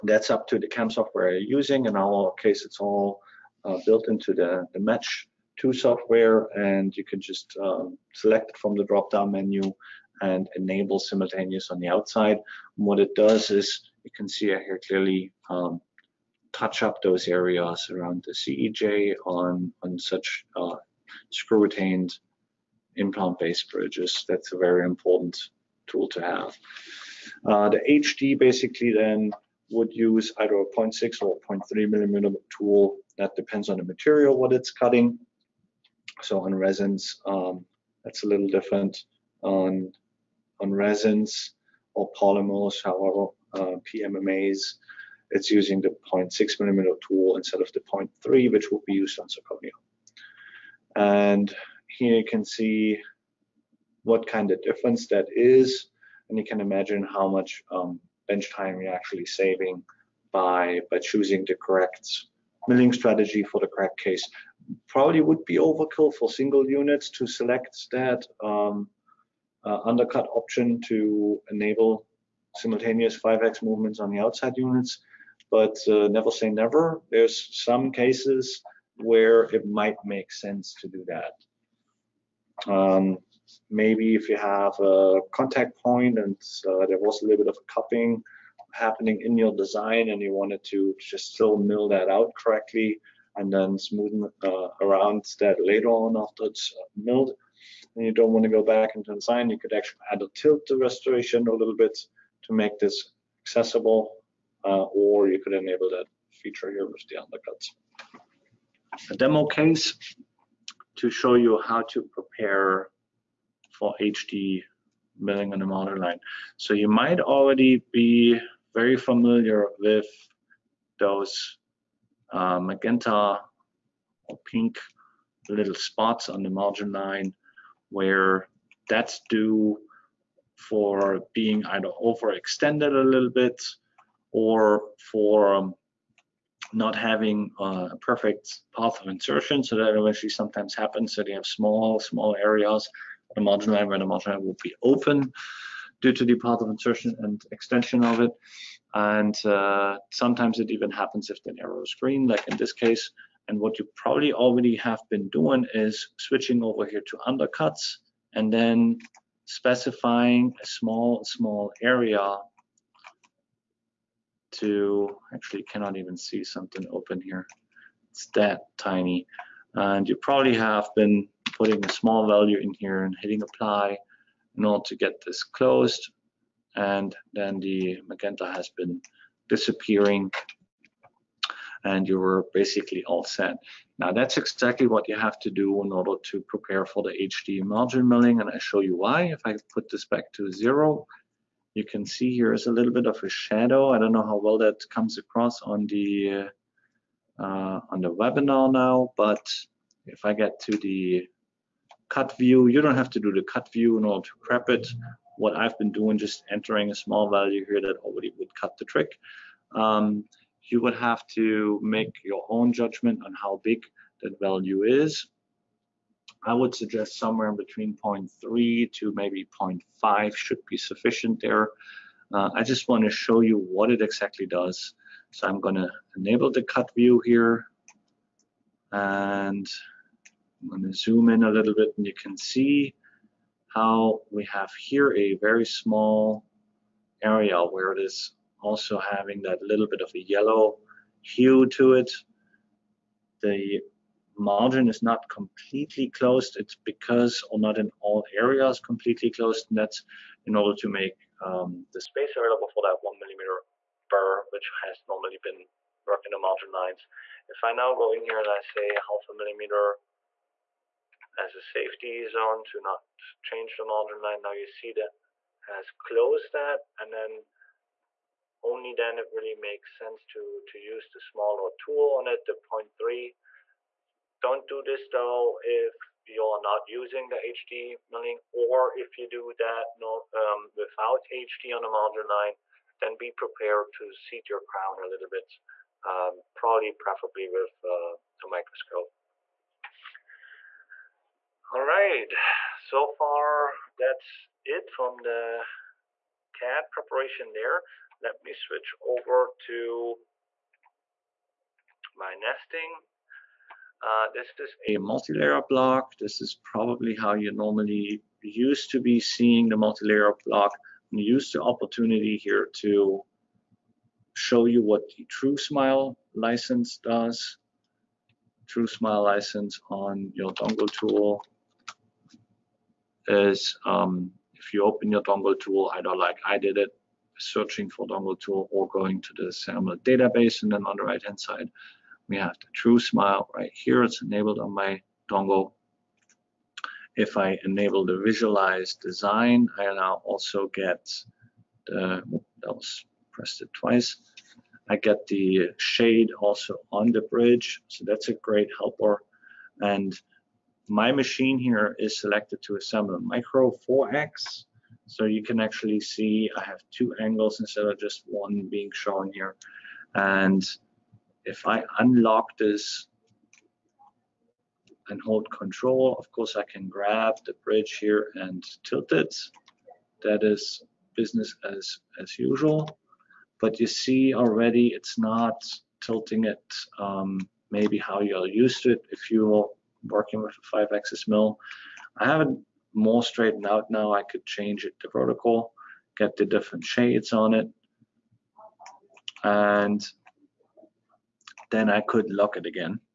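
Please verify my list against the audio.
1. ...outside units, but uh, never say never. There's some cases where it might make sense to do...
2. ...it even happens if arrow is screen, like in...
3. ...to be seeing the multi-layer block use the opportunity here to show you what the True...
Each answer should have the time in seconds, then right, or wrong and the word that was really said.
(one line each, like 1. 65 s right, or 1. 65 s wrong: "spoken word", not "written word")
1. 74 s right
2. 150 s right
3. 308 s right.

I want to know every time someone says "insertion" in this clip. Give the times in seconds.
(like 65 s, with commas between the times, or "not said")
139 s, 146 s.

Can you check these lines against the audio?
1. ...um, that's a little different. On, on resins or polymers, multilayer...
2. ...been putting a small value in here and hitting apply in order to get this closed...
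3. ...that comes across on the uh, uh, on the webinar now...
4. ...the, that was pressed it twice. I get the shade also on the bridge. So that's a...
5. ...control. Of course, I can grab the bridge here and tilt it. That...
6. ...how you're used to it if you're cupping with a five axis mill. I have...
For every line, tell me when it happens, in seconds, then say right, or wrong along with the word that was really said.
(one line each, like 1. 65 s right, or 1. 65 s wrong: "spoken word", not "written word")
1. 37 s wrong: "however", not "multilayer"
2. 170 s right
3. 194 s right
4. 341 s right
5. 365 s right
6. 377 s wrong: "working", not "cupping".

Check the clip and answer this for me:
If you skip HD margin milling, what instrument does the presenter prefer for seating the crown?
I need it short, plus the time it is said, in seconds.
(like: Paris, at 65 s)
A microscope, at 288 s.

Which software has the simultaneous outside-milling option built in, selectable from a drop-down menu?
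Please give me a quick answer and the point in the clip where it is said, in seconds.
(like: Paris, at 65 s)
Match 2, at 4 s.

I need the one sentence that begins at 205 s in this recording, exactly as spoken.
What I've been doing, just entering a small value here that already would cut the trick.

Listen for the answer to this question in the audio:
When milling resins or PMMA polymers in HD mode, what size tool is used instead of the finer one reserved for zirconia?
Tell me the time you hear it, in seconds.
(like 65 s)
46 s.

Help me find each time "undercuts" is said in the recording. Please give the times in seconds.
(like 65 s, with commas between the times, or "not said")
69 s, 107 s, 157 s.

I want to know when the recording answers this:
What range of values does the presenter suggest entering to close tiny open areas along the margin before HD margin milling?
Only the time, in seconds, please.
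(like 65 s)
218 s.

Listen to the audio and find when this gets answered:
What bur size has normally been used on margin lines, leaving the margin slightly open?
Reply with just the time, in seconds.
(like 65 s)
253 s.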